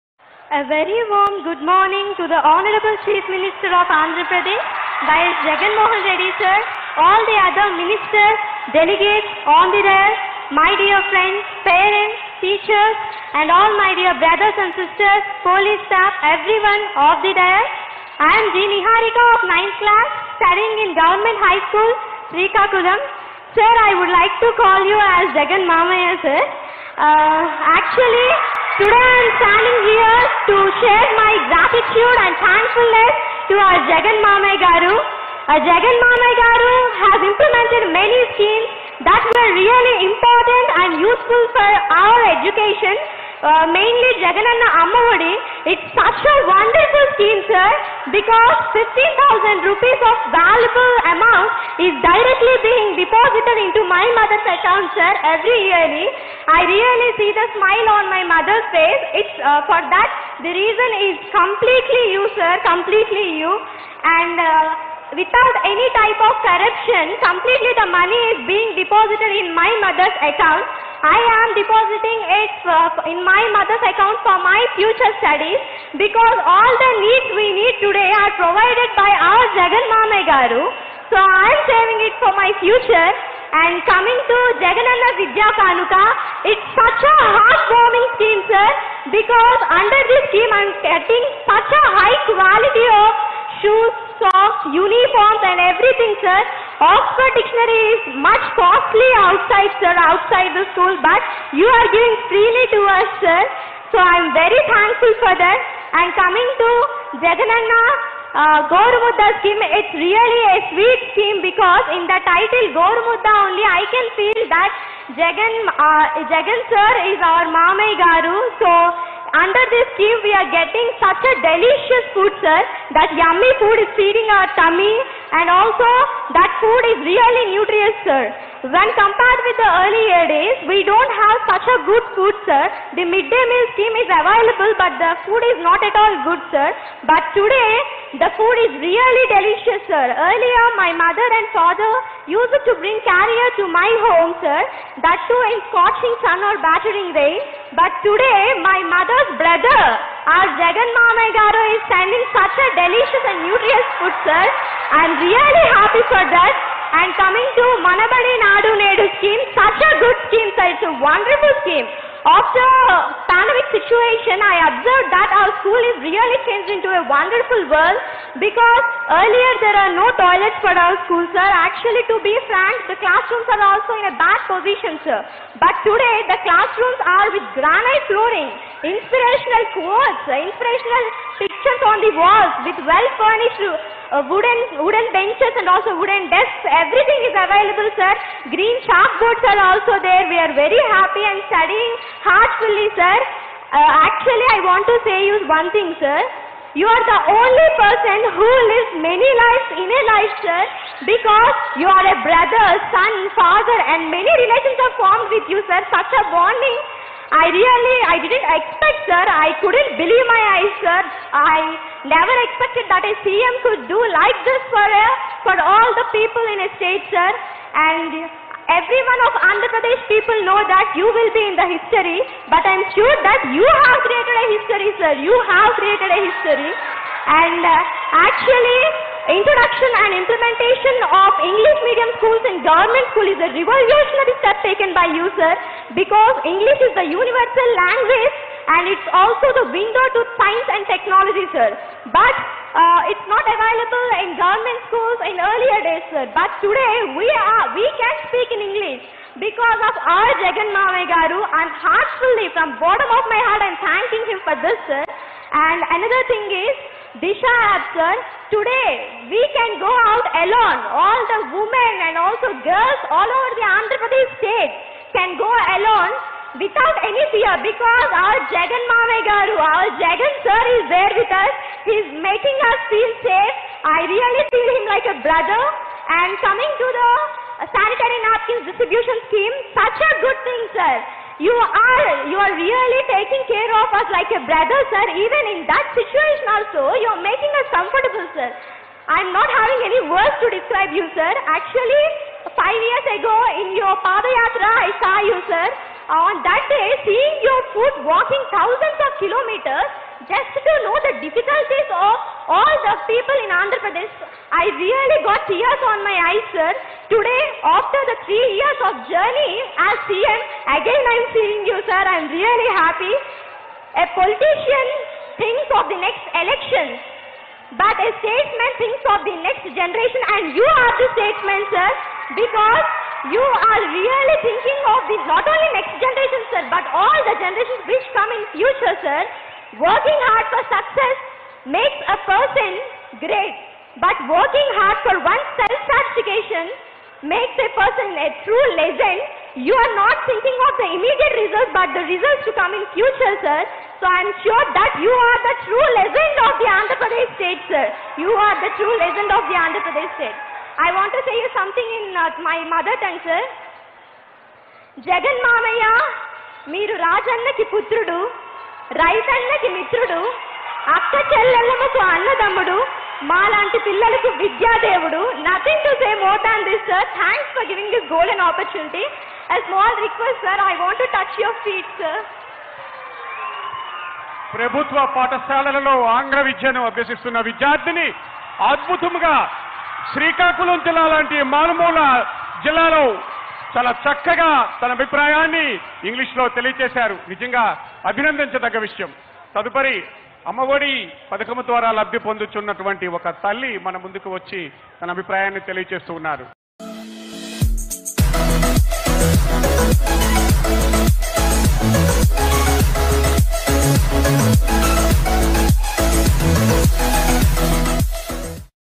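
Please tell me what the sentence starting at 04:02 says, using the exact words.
But uh, it's not available in government schools in earlier days, sir.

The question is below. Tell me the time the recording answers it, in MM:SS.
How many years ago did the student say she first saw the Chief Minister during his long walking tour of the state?
04:52.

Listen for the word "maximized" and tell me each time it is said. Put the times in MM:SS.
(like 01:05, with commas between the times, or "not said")
not said.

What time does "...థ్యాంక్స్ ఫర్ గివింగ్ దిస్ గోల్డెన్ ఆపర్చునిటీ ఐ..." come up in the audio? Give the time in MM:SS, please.
06:07.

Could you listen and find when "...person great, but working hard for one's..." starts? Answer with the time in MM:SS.
05:32.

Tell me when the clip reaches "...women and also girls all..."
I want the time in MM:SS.
04:21.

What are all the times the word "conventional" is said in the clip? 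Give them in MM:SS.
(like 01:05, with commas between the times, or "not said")
not said.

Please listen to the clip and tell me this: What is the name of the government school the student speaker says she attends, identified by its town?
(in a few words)
Government High School, Srikakulam.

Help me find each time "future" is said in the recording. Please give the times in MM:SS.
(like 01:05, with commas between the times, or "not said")
01:14, 01:22, 05:28, 05:42.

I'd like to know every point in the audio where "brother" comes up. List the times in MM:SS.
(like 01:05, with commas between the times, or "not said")
00:14, 02:29, 03:22, 04:35, 04:44.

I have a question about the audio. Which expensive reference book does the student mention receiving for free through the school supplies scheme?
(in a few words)
Oxford Dictionary.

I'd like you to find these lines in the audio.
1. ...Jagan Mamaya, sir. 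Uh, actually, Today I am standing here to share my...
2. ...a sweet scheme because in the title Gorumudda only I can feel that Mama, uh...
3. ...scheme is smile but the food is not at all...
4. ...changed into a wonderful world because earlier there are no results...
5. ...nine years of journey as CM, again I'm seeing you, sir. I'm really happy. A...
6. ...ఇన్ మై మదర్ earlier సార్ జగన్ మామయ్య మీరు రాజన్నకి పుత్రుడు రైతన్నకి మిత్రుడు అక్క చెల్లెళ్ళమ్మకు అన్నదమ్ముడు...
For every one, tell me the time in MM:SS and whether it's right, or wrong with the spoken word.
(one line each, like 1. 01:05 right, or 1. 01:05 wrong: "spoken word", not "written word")
1. 00:25 right
2. 01:50 wrong: "Jagan", not "Mama"
3. 02:13 wrong: "available", not "smile"
4. 02:46 wrong: "toilets", not "results"
5. 05:08 wrong: "three", not "nine"
6. 05:51 wrong: "mother", not "earlier".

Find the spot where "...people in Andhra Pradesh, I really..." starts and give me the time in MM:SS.
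05:03.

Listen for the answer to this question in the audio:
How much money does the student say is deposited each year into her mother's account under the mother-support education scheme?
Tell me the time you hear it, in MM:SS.
00:48.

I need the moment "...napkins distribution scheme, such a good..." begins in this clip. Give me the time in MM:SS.
04:38.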